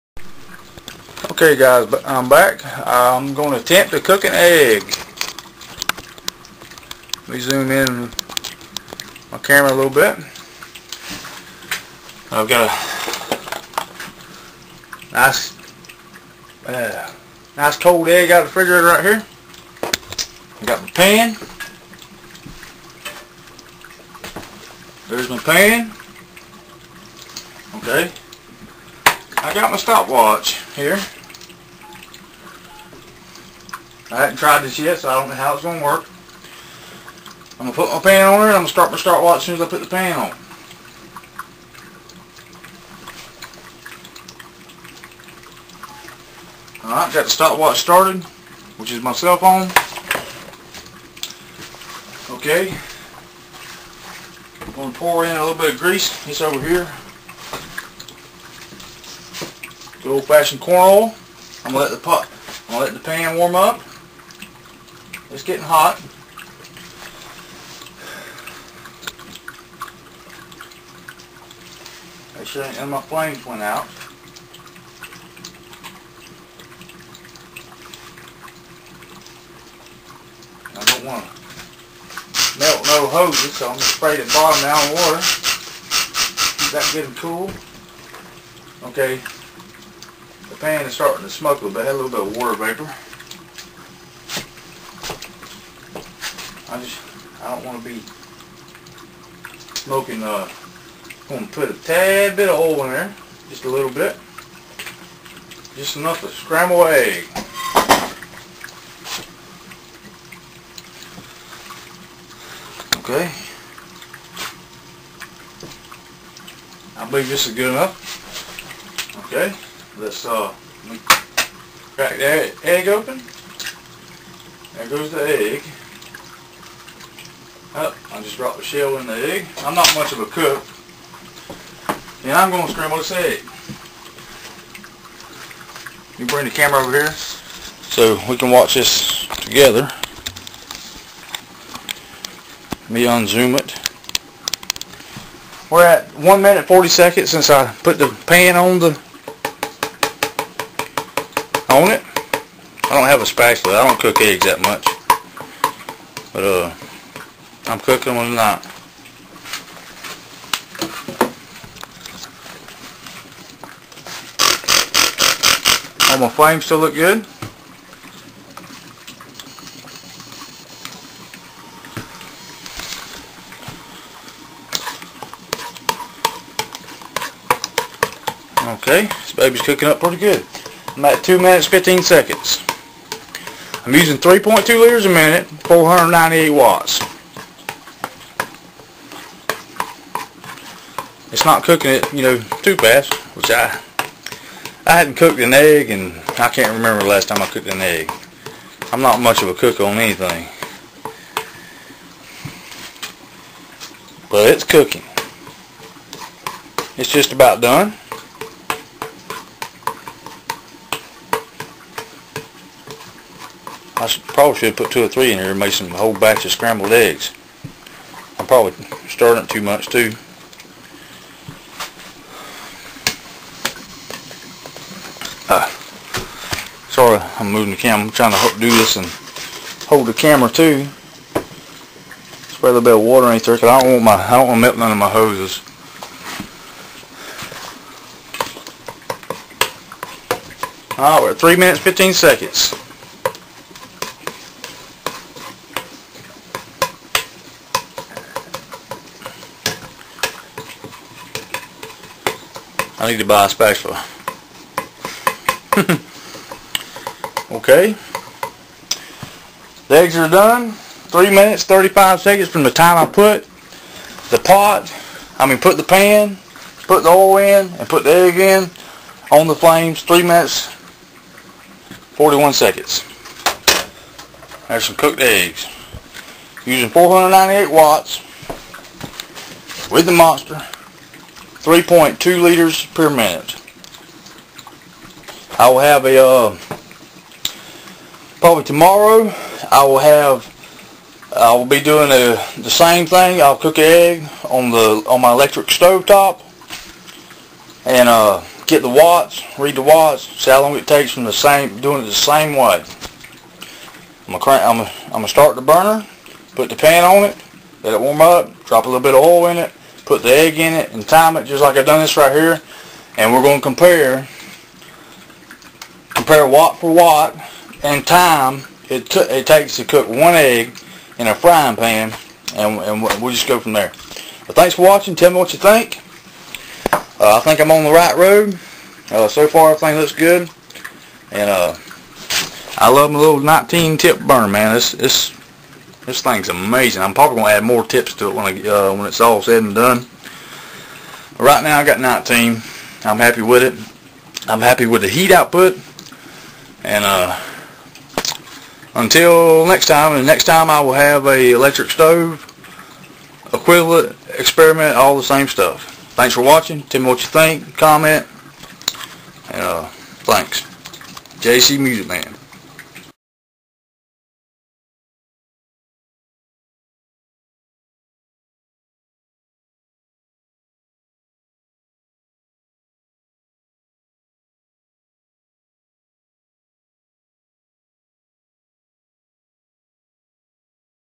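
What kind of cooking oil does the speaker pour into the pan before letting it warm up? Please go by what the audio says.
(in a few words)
Corn oil.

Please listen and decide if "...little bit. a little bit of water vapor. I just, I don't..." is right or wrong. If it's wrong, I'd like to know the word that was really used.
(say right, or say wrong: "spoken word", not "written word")
right.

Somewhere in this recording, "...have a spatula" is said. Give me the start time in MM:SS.
02:33.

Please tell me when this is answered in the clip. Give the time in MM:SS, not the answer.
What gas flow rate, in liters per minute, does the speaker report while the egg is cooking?
03:04.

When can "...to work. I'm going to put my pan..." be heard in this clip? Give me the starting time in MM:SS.
00:35.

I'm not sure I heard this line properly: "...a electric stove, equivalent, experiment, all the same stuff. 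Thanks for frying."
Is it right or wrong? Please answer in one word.
wrong.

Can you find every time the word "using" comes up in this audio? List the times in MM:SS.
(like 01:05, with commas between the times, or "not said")
03:03, 04:36.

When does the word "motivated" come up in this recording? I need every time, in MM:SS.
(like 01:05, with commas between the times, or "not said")
not said.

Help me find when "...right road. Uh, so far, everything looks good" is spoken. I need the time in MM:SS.
05:27.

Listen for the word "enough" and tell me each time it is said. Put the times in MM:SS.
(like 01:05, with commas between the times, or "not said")
01:45, 01:57.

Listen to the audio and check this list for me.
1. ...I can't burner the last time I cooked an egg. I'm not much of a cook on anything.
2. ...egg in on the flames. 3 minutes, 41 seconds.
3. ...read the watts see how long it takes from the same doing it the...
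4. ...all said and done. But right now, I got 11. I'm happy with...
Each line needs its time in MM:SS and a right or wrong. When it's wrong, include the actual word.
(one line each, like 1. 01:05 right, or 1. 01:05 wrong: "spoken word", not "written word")
1. 03:16 wrong: "remember", not "burner"
2. 04:28 right
3. 04:59 right
4. 05:39 wrong: "19", not "11".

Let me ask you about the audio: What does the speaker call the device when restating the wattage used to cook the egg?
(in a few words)
The monster.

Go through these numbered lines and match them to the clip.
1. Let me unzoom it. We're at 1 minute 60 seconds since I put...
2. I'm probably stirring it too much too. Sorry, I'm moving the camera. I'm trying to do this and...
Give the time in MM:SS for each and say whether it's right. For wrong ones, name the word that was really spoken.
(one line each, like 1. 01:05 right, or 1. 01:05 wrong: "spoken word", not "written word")
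1. 02:22 wrong: "40", not "60"
2. 03:38 right.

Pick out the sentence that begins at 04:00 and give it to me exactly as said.
Alright, we're at 3 minutes 15 seconds.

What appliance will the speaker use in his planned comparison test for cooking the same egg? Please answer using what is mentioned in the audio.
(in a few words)
Electric stove top.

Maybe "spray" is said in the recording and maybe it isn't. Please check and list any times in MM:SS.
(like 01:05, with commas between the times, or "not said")
01:23, 03:52.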